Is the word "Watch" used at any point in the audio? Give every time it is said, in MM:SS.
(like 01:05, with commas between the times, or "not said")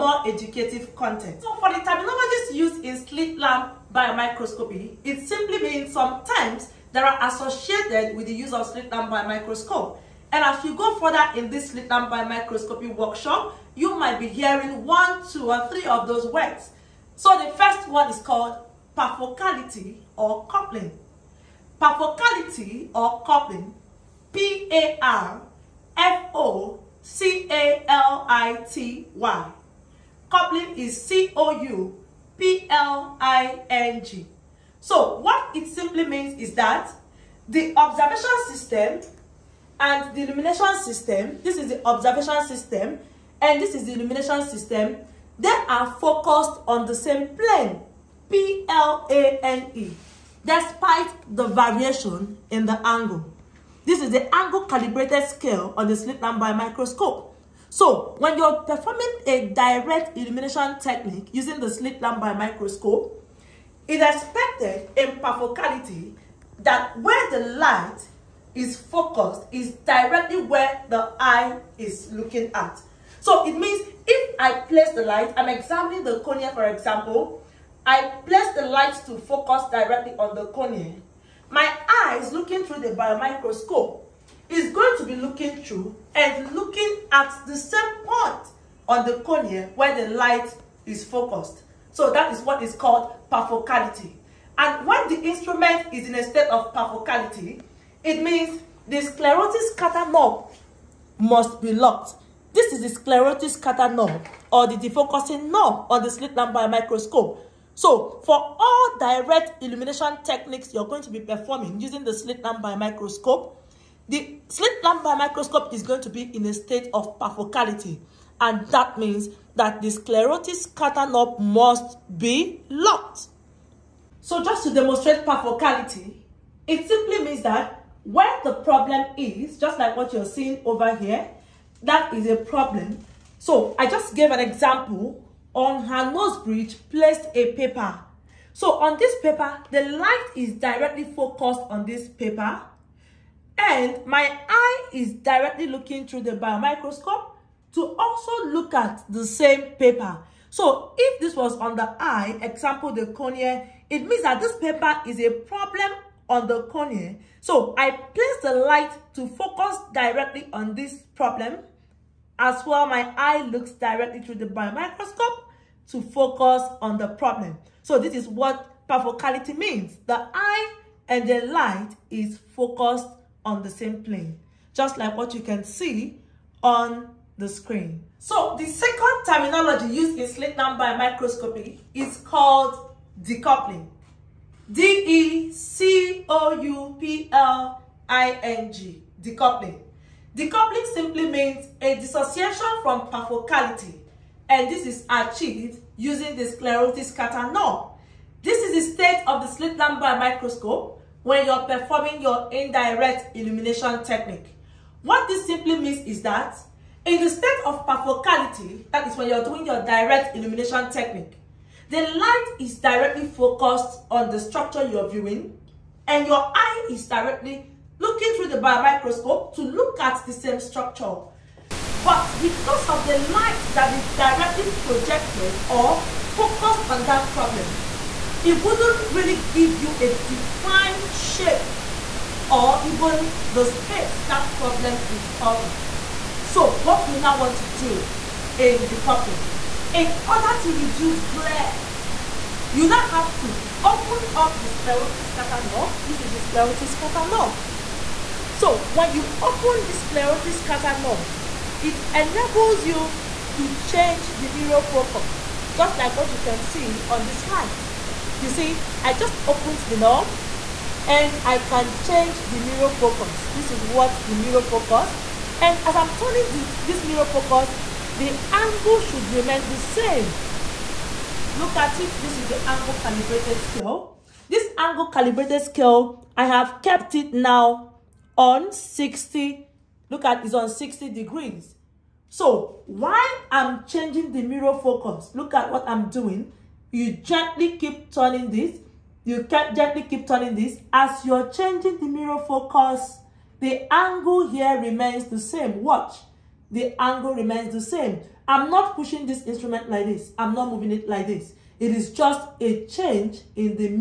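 04:55.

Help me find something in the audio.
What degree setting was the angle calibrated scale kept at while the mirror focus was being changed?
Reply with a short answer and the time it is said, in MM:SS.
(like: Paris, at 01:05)
60 degrees, at 04:40.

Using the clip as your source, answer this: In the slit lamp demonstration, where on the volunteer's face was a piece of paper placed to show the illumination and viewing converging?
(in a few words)
Nose bridge.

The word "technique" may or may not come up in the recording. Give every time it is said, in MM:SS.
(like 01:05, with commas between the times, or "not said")
01:00, 01:50, 03:24, 03:30.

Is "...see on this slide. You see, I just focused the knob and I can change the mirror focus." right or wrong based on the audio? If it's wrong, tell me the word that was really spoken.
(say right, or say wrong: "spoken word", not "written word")
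wrong: "opened", not "focused".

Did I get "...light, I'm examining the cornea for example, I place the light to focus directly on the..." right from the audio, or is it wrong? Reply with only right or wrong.
right.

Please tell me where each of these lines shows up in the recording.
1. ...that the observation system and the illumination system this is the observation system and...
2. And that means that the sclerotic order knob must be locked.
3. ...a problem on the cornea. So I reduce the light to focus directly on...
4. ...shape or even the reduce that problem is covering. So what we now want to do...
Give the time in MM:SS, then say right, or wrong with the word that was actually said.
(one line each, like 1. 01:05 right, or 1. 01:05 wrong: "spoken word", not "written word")
1. 00:36 right
2. 01:58 wrong: "scatter", not "order"
3. 02:35 wrong: "place", not "reduce"
4. 03:51 wrong: "space", not "reduce".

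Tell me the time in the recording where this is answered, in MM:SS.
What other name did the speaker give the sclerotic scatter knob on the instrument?
01:44.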